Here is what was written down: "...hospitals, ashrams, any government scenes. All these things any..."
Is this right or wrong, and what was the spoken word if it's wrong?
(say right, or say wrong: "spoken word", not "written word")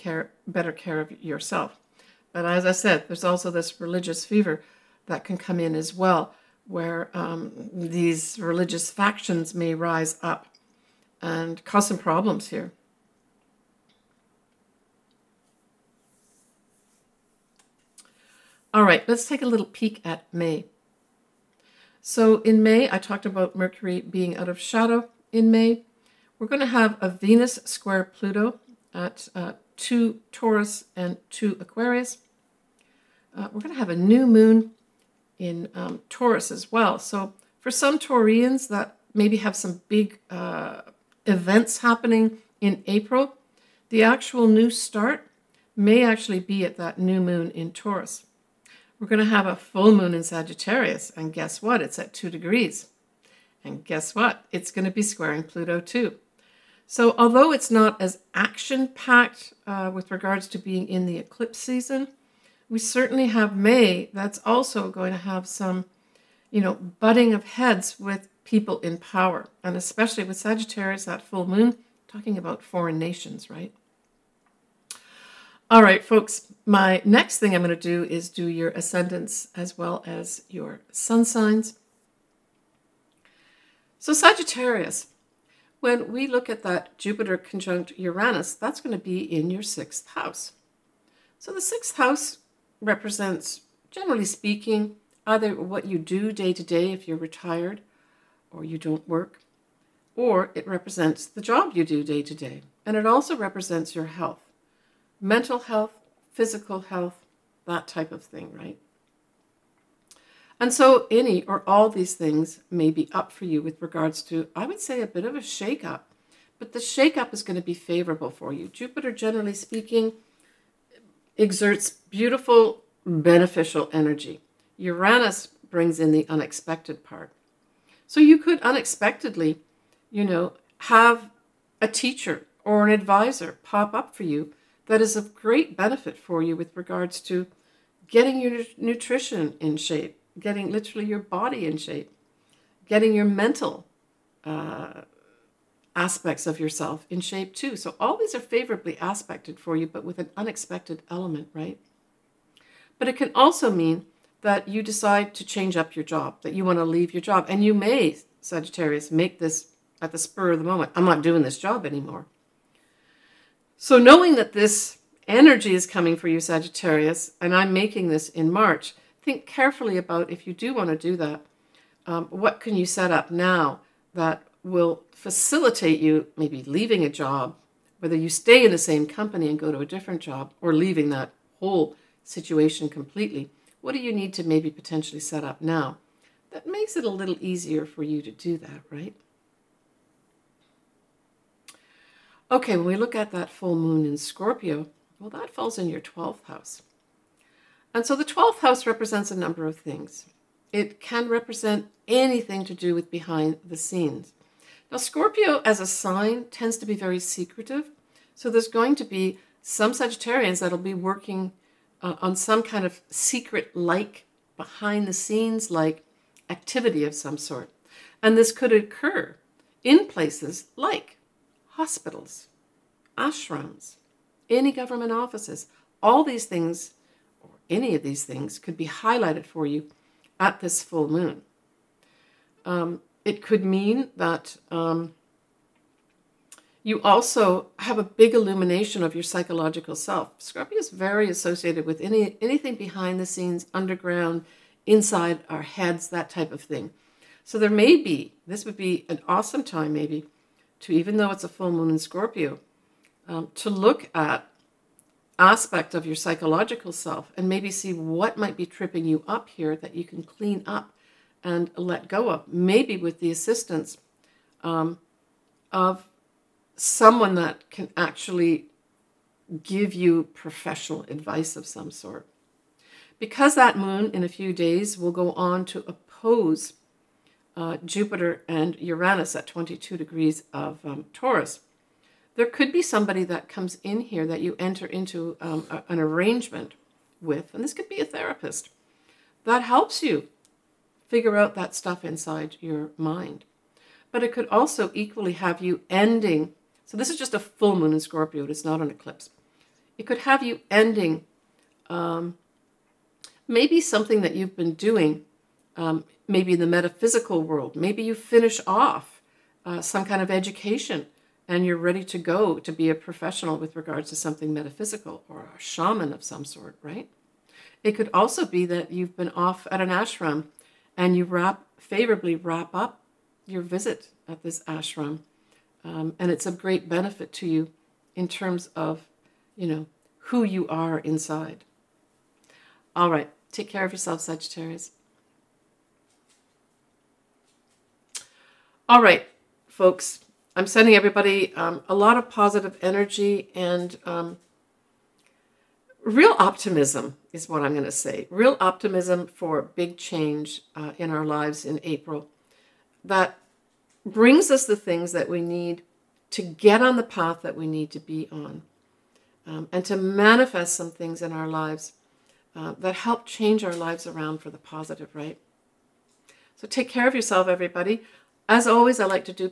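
wrong: "offices", not "scenes".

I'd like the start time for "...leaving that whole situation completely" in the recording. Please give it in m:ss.
3:00.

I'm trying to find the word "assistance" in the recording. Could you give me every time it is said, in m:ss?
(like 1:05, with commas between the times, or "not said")
4:23.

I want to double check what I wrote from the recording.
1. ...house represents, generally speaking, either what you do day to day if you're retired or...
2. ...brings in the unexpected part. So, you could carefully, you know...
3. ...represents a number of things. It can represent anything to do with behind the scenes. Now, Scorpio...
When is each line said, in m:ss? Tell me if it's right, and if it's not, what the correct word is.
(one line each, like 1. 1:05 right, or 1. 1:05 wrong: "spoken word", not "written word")
1. 1:31 right
2. 2:05 wrong: "unexpectedly", not "carefully"
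3. 3:18 right.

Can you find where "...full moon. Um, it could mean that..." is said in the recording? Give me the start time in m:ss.
3:50.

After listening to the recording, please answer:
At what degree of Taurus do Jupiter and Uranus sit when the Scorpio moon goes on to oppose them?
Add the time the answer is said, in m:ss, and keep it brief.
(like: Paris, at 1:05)
22, at 4:39.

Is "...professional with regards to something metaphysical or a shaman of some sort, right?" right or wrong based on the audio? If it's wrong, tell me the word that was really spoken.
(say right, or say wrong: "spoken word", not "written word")
right.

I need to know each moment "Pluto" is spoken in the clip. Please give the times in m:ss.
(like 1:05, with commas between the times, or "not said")
0:28, 0:55.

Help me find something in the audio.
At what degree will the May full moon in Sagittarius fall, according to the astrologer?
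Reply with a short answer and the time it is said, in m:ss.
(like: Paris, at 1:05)
2, at 0:51.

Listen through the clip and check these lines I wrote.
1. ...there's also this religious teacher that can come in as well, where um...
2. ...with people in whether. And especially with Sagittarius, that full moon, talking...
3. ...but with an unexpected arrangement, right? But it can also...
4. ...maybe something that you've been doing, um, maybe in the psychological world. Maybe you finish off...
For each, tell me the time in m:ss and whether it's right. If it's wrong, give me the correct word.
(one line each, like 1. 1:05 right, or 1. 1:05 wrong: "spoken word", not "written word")
1. 0:03 wrong: "fever", not "teacher"
2. 1:07 wrong: "power", not "whether"
3. 2:29 wrong: "element", not "arrangement"
4. 5:03 wrong: "metaphysical", not "psychological".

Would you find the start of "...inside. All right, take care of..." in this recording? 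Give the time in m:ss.
5:30.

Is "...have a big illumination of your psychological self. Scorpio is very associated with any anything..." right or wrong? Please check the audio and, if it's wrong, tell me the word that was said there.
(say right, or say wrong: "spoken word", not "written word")
right.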